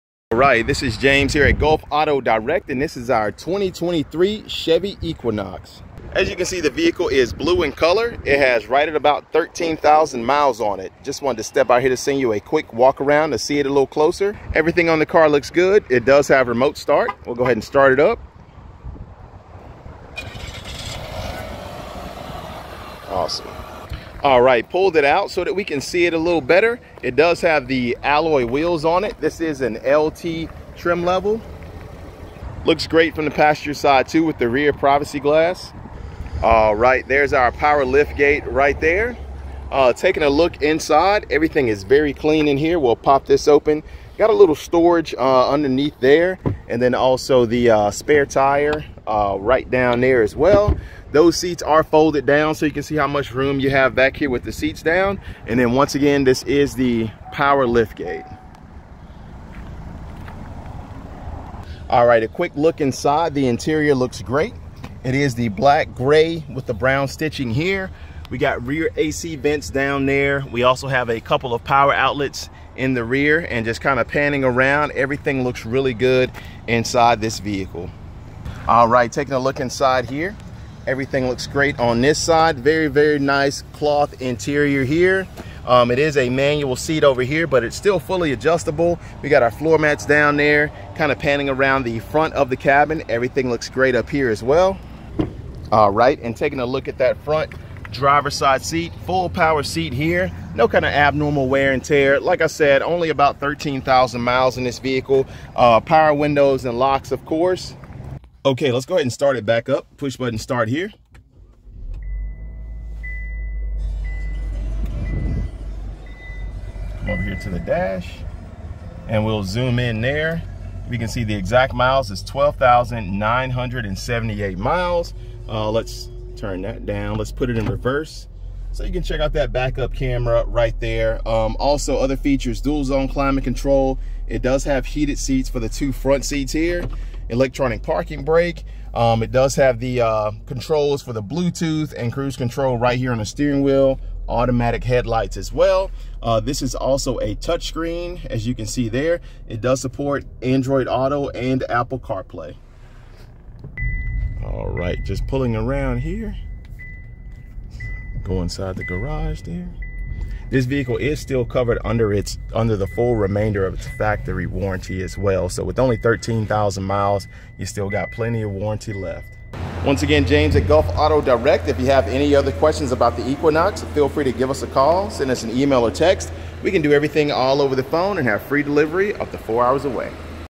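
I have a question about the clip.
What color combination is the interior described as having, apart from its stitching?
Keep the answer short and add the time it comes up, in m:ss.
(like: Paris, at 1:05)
black gray, at 1:05.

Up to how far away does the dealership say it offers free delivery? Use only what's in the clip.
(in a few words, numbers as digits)
4 hours.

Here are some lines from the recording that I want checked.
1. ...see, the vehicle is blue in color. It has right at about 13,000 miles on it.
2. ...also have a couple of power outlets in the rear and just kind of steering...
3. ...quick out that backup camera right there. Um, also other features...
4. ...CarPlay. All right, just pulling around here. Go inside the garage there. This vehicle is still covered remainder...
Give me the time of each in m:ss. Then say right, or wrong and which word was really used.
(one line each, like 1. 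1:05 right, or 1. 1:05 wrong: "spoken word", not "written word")
1. 0:06 right
2. 1:10 wrong: "panning", not "steering"
3. 2:09 wrong: "check", not "quick"
4. 2:31 wrong: "under", not "remainder".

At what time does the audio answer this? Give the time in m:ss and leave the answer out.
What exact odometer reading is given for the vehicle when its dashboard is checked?
2:02.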